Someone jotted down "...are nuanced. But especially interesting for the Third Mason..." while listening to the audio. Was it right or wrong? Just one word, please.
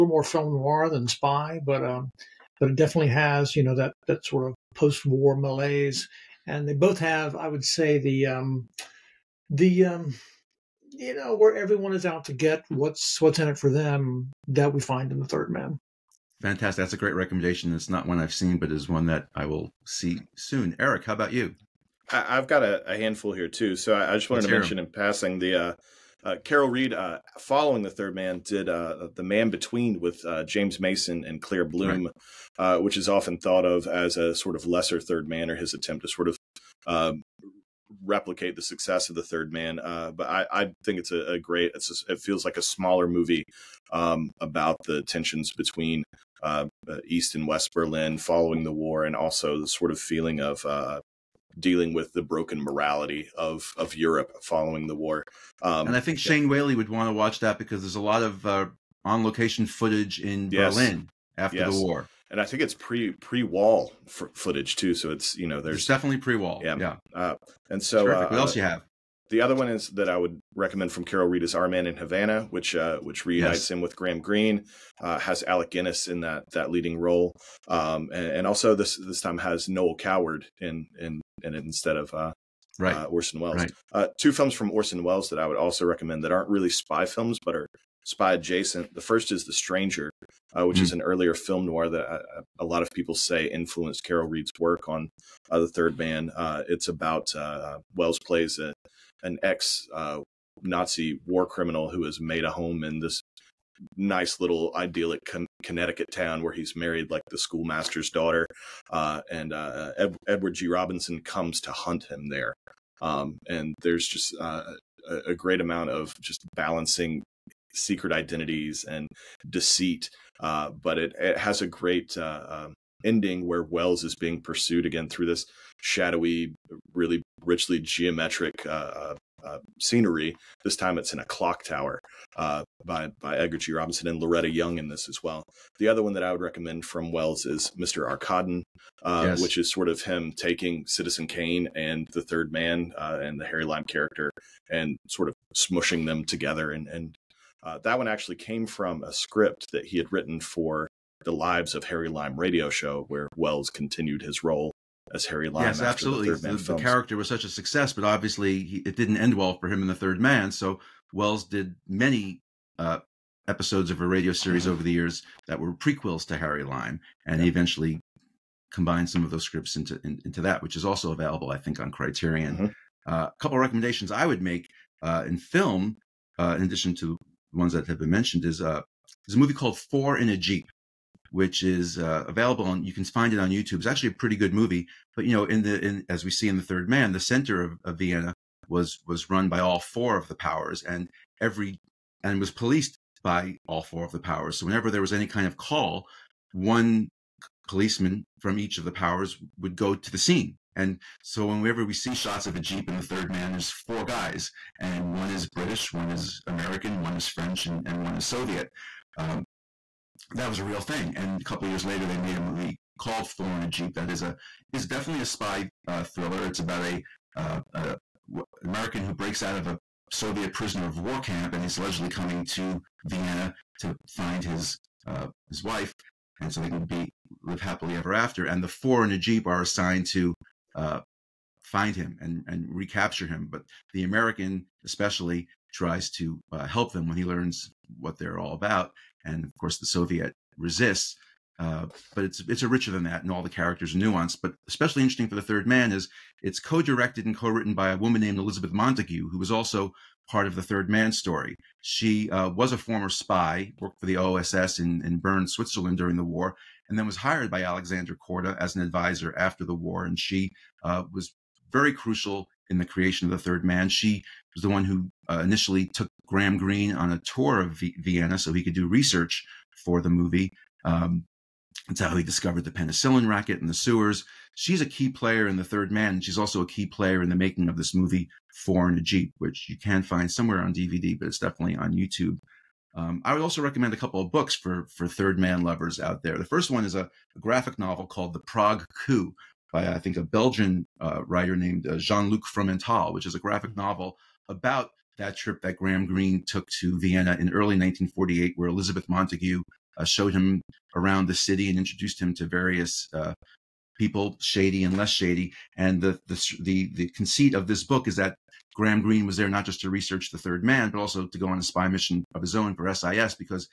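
wrong.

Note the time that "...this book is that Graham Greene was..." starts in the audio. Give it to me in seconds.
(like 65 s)
307 s.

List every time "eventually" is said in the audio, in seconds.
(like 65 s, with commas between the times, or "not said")
167 s.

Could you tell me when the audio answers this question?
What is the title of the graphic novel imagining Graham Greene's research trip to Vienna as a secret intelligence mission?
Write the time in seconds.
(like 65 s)
288 s.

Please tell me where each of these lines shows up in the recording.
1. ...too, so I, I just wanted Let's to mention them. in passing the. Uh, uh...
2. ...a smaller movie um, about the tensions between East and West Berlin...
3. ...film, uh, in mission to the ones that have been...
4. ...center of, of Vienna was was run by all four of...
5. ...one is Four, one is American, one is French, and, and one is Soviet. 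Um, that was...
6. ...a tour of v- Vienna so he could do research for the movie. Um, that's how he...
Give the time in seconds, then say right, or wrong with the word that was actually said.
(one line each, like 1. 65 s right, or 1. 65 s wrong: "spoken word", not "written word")
1. 23 s right
2. 42 s right
3. 175 s wrong: "addition", not "mission"
4. 187 s right
5. 205 s wrong: "British", not "Four"
6. 267 s right.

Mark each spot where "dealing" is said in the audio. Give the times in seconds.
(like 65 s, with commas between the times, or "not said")
51 s.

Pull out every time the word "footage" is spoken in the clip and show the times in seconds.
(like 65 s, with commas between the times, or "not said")
59 s, 64 s.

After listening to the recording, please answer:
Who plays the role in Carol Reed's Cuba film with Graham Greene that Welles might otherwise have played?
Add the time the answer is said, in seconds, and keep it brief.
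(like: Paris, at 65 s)
Noel Coward, at 79 s.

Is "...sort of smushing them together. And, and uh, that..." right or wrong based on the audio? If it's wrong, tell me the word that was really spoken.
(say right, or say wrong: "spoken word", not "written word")
right.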